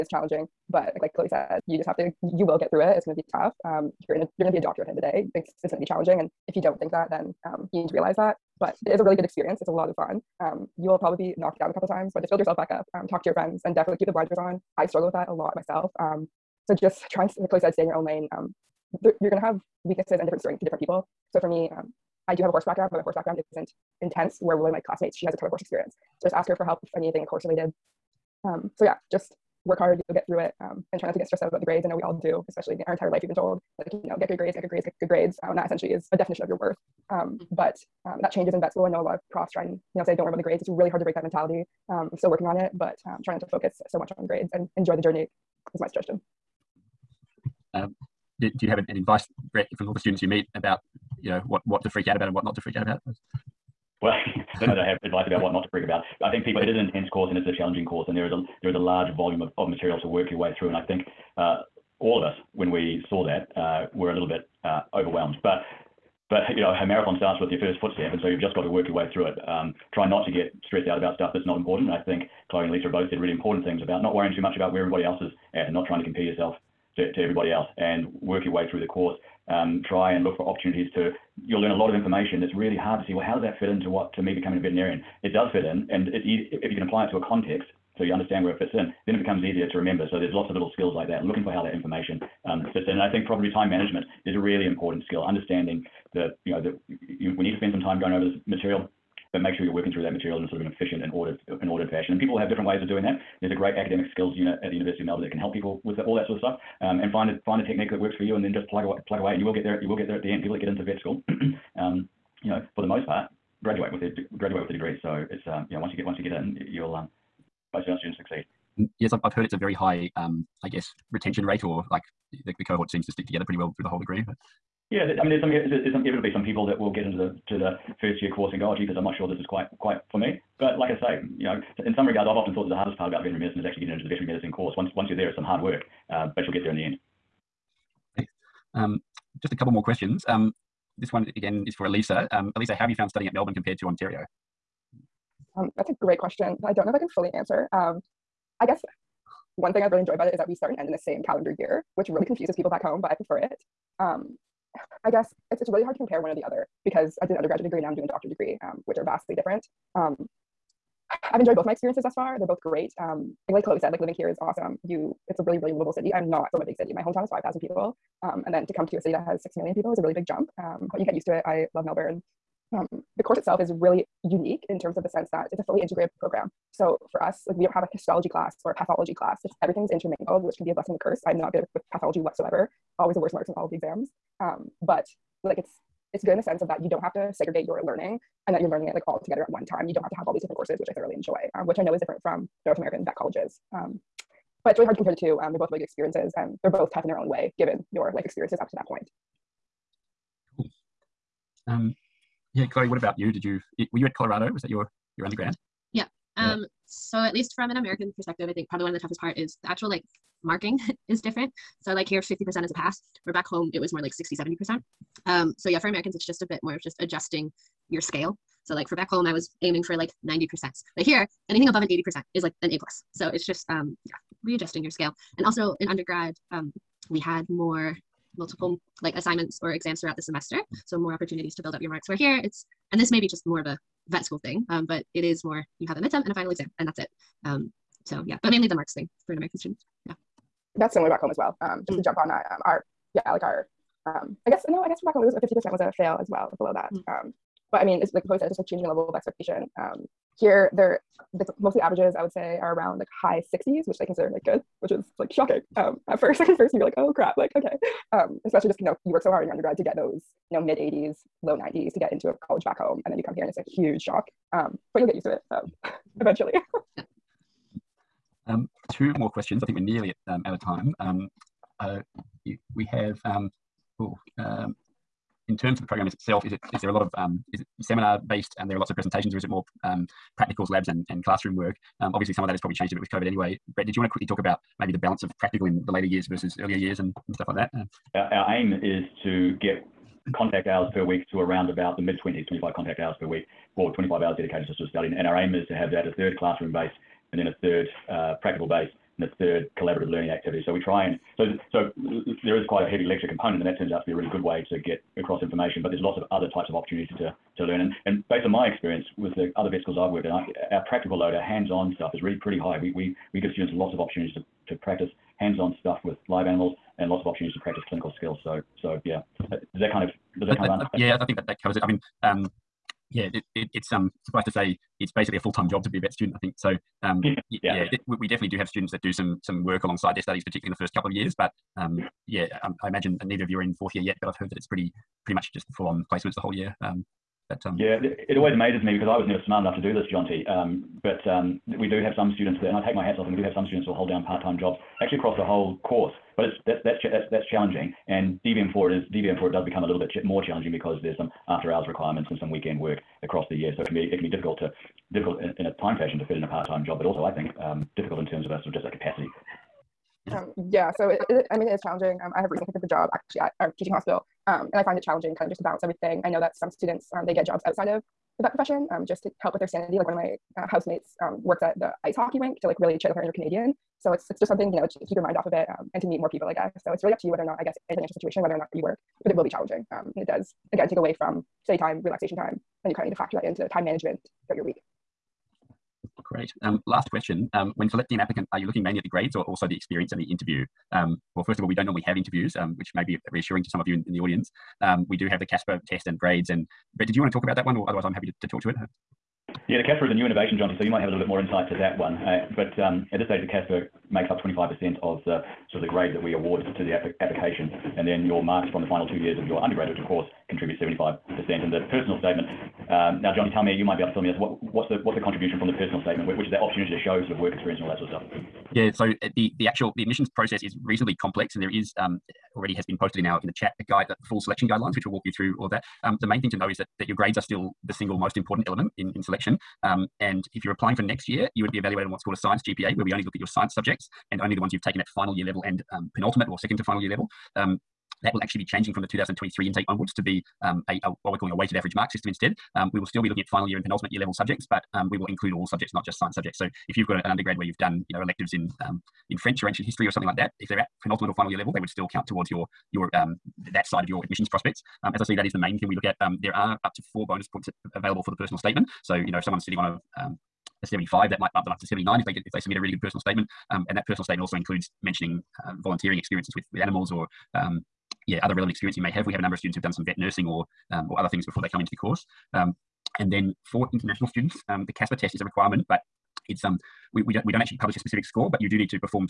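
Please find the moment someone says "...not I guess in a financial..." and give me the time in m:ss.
6:17.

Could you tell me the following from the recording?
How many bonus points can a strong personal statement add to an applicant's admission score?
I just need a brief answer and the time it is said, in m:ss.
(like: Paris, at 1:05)
4, at 7:37.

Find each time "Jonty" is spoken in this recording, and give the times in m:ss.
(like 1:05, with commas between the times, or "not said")
5:40, 6:40, 6:53.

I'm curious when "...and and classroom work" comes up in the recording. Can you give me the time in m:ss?
4:40.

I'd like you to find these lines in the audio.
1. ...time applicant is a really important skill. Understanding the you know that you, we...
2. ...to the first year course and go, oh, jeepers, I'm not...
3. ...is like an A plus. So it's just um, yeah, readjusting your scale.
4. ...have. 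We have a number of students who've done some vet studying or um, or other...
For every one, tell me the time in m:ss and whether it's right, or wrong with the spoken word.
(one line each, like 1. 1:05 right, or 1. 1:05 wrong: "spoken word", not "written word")
1. 1:33 wrong: "management", not "applicant"
2. 2:07 right
3. 3:42 right
4. 7:49 wrong: "nursing", not "studying".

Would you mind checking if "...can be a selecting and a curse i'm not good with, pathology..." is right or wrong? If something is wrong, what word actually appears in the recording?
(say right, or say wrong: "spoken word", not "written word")
wrong: "blessing", not "selecting".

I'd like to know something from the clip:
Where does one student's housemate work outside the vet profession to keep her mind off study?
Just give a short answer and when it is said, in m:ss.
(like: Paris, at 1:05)
ice hockey rink, at 6:12.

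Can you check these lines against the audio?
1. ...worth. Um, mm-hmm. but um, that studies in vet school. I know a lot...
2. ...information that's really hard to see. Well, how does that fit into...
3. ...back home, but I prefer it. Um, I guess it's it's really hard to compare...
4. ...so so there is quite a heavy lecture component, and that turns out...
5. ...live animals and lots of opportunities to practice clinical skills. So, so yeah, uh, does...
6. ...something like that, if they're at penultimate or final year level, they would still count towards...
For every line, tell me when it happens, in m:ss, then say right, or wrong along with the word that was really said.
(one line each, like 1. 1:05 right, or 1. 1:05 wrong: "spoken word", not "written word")
1. 0:36 wrong: "changes", not "studies"
2. 1:21 right
3. 2:32 right
4. 5:01 right
5. 5:16 right
6. 7:30 right.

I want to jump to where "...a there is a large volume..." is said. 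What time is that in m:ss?
0:58.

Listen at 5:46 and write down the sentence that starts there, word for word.
But it's that's that's that's that's challenging.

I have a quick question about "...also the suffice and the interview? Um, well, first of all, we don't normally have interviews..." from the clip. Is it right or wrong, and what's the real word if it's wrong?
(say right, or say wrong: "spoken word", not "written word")
wrong: "experience", not "suffice".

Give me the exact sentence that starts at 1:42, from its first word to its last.
And people have different ways of doing that.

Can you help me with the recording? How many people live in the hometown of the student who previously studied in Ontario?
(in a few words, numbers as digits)
5,000.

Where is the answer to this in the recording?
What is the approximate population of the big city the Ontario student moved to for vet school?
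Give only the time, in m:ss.
2:49.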